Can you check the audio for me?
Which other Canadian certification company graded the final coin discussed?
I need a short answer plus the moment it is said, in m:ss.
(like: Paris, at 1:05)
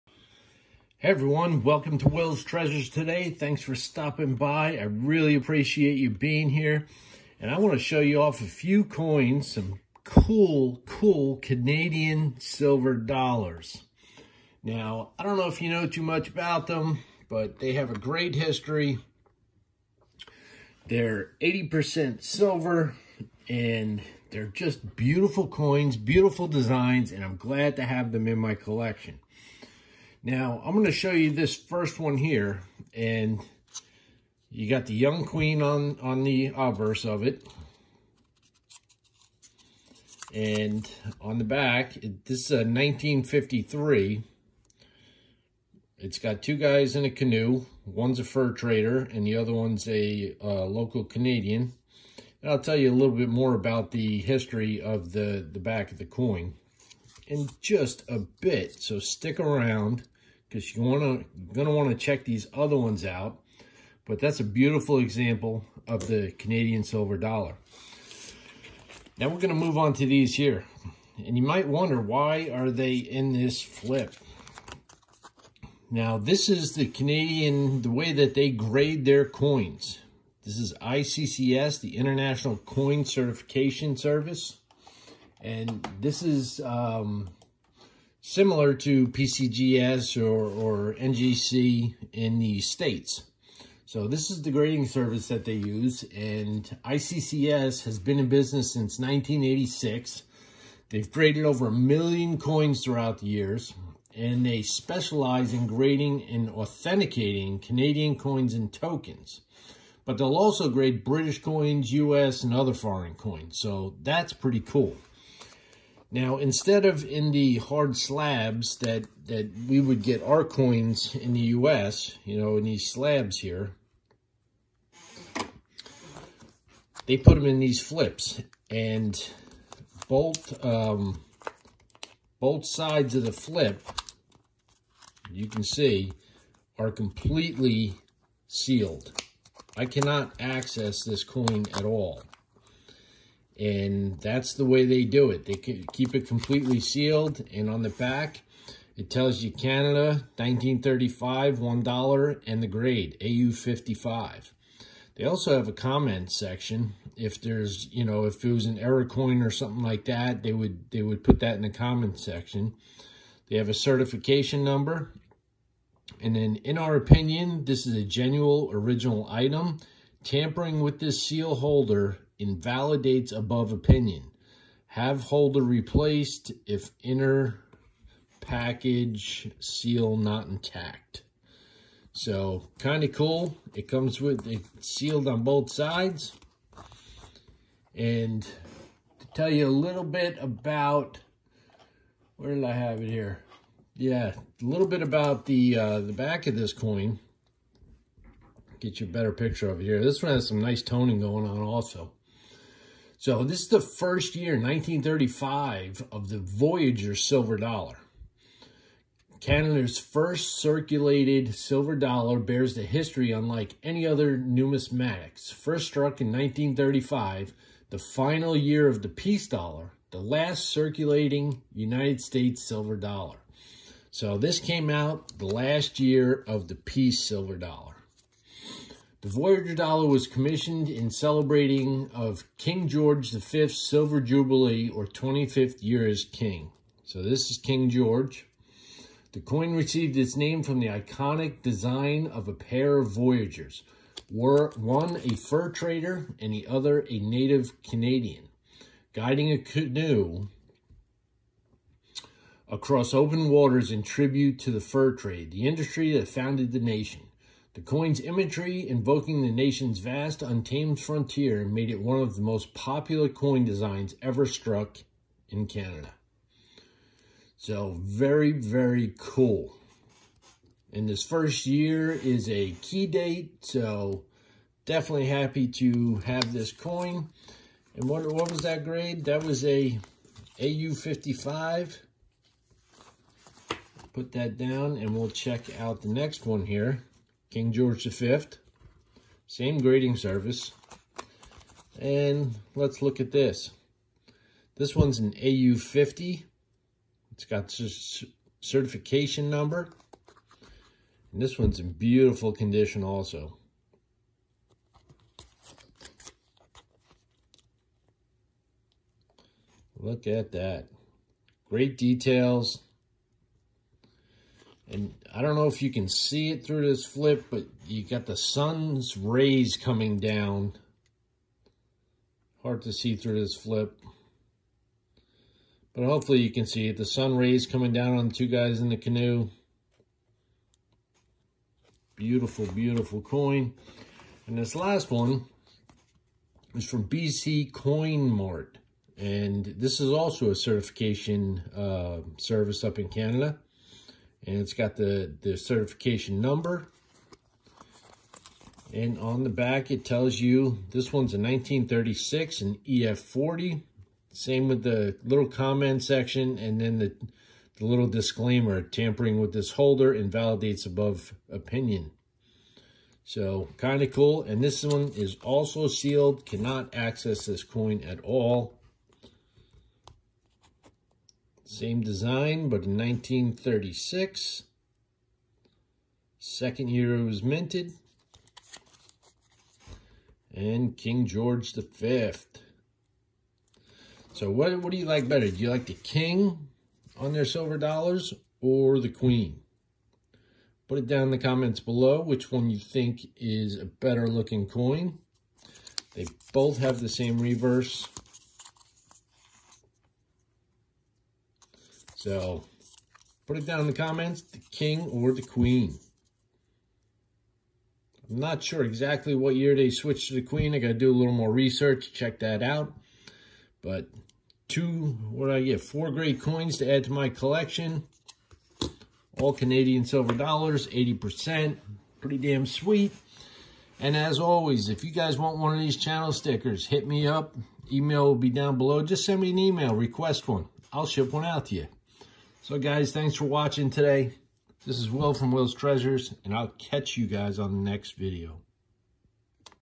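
BC Coin Mart, at 5:37.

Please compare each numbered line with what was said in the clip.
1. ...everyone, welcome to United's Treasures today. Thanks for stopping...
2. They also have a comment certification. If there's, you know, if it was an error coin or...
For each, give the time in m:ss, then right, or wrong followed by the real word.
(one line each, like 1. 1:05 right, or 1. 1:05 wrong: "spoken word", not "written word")
1. 0:01 wrong: "Will", not "United"
2. 2:35 wrong: "section", not "certification".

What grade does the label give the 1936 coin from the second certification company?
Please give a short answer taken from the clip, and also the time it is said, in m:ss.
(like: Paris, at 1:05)
EF40, at 5:52.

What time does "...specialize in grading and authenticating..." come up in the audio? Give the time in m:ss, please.
1:44.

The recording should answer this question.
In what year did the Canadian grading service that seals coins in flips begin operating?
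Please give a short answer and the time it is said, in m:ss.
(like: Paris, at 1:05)
1986, at 1:38.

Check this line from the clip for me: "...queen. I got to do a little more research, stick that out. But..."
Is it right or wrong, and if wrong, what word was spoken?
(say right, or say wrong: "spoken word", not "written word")
wrong: "check", not "stick".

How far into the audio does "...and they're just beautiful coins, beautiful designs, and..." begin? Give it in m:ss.
0:23.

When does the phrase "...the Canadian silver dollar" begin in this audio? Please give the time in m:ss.
1:06.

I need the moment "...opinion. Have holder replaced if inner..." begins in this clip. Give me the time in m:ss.
2:53.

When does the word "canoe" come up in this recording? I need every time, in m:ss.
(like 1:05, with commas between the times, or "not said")
0:47, 4:09, 5:28.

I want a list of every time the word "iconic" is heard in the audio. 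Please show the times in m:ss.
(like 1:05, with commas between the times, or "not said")
4:00.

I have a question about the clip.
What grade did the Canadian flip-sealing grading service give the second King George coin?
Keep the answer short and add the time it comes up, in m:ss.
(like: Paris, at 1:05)
AU50, at 4:55.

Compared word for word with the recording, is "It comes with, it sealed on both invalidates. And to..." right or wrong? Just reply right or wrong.
wrong.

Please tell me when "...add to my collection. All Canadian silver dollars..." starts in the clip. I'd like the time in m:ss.
6:56.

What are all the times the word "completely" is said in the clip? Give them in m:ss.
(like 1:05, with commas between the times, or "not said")
2:16, 2:26.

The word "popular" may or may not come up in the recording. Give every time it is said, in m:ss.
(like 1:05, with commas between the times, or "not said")
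4:22.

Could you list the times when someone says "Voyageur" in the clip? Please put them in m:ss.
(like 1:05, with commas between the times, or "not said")
3:26, 3:49, 4:03.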